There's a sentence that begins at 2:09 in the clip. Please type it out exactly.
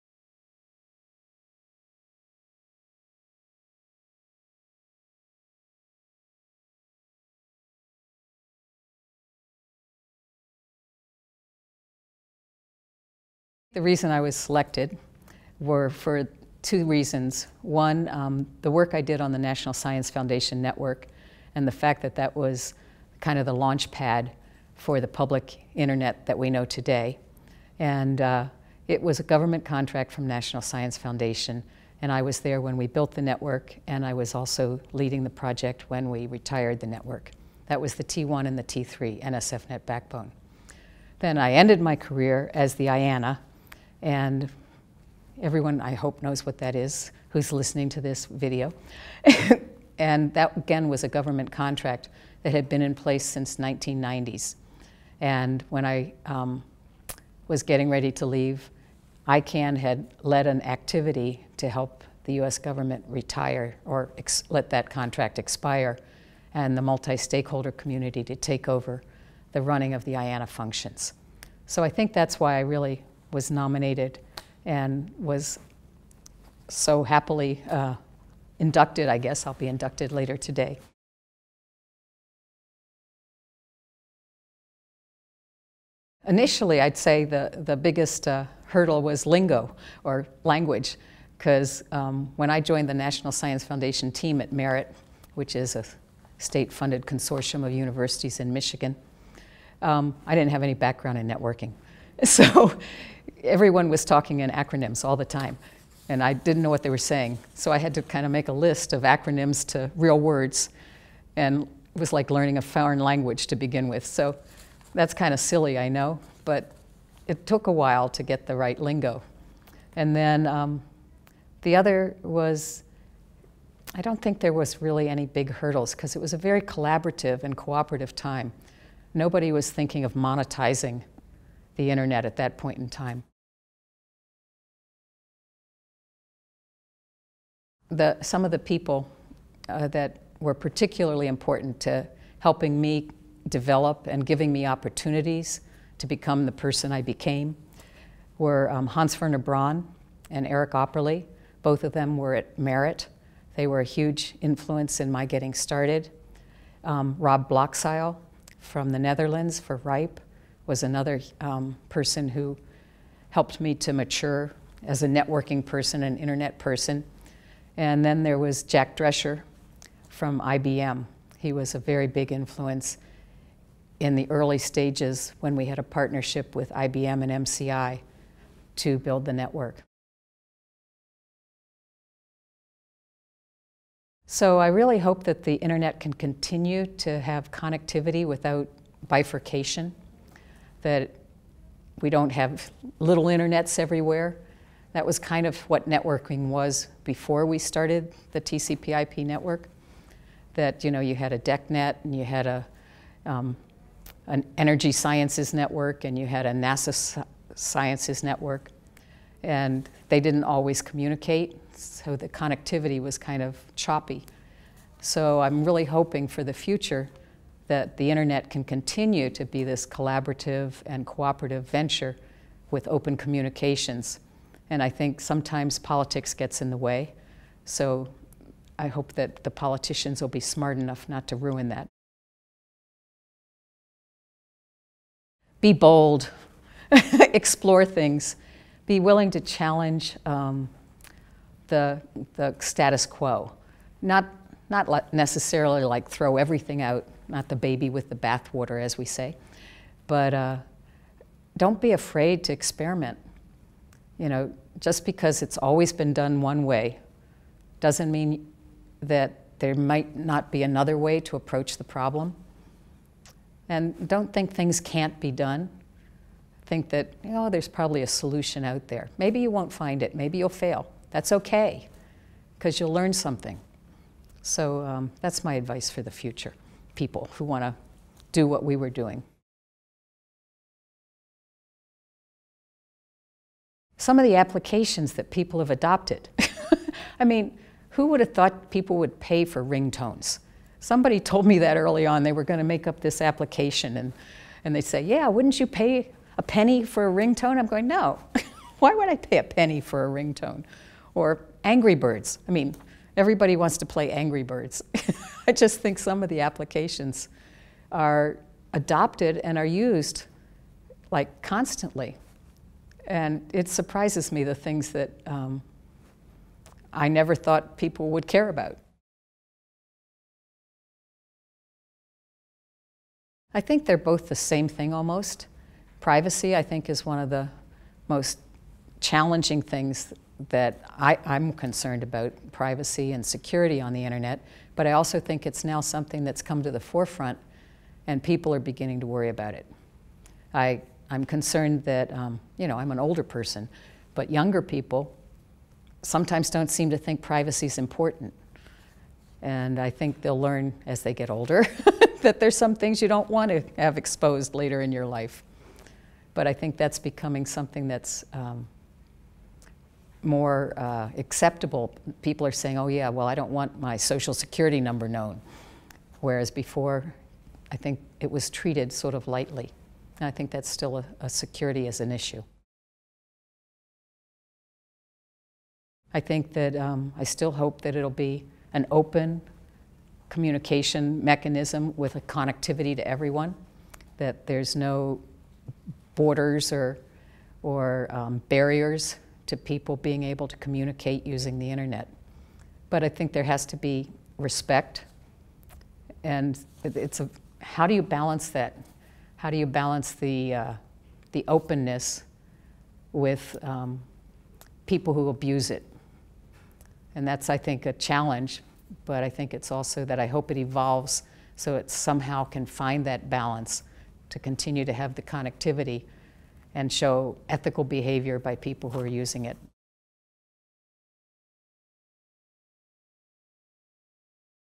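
Nobody was thinking of monetizing the internet at that point in time.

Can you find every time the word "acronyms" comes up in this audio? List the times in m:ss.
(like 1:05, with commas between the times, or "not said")
1:44, 1:49.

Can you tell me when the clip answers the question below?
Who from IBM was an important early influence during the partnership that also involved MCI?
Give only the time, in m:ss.
2:48.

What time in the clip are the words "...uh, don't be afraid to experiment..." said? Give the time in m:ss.
4:10.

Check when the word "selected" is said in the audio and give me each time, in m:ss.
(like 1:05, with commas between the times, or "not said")
0:14.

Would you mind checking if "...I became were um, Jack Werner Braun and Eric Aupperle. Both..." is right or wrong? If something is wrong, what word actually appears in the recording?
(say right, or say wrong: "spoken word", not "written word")
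wrong: "Hans", not "Jack".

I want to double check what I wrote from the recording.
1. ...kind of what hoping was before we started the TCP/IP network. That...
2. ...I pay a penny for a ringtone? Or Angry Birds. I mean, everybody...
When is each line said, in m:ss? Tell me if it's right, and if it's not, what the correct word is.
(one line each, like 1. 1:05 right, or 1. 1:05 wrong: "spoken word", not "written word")
1. 3:15 wrong: "networking", not "hoping"
2. 4:59 right.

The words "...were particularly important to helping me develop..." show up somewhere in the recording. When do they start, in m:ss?
2:20.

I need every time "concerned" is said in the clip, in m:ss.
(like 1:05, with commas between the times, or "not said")
5:31, 5:41.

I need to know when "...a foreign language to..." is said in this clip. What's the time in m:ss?
1:52.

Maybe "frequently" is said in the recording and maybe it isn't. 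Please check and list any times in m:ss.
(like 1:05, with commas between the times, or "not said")
not said.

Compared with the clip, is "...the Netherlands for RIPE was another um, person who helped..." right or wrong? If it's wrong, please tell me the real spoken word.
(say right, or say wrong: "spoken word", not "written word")
right.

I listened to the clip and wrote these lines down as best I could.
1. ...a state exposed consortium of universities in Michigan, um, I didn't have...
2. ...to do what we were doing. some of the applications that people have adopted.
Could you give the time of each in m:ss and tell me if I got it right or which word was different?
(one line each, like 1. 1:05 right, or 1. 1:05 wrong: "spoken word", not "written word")
1. 1:35 wrong: "funded", not "exposed"
2. 4:37 right.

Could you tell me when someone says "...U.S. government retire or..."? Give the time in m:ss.
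1:02.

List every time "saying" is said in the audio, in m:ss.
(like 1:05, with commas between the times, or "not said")
1:46, 6:02.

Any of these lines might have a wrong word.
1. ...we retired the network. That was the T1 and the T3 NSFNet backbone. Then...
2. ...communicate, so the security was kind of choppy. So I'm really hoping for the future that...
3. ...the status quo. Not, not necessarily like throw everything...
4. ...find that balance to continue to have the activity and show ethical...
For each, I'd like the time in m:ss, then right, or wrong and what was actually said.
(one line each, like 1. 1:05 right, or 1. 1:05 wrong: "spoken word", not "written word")
1. 0:36 right
2. 3:30 wrong: "connectivity", not "security"
3. 4:02 right
4. 6:52 wrong: "connectivity", not "activity".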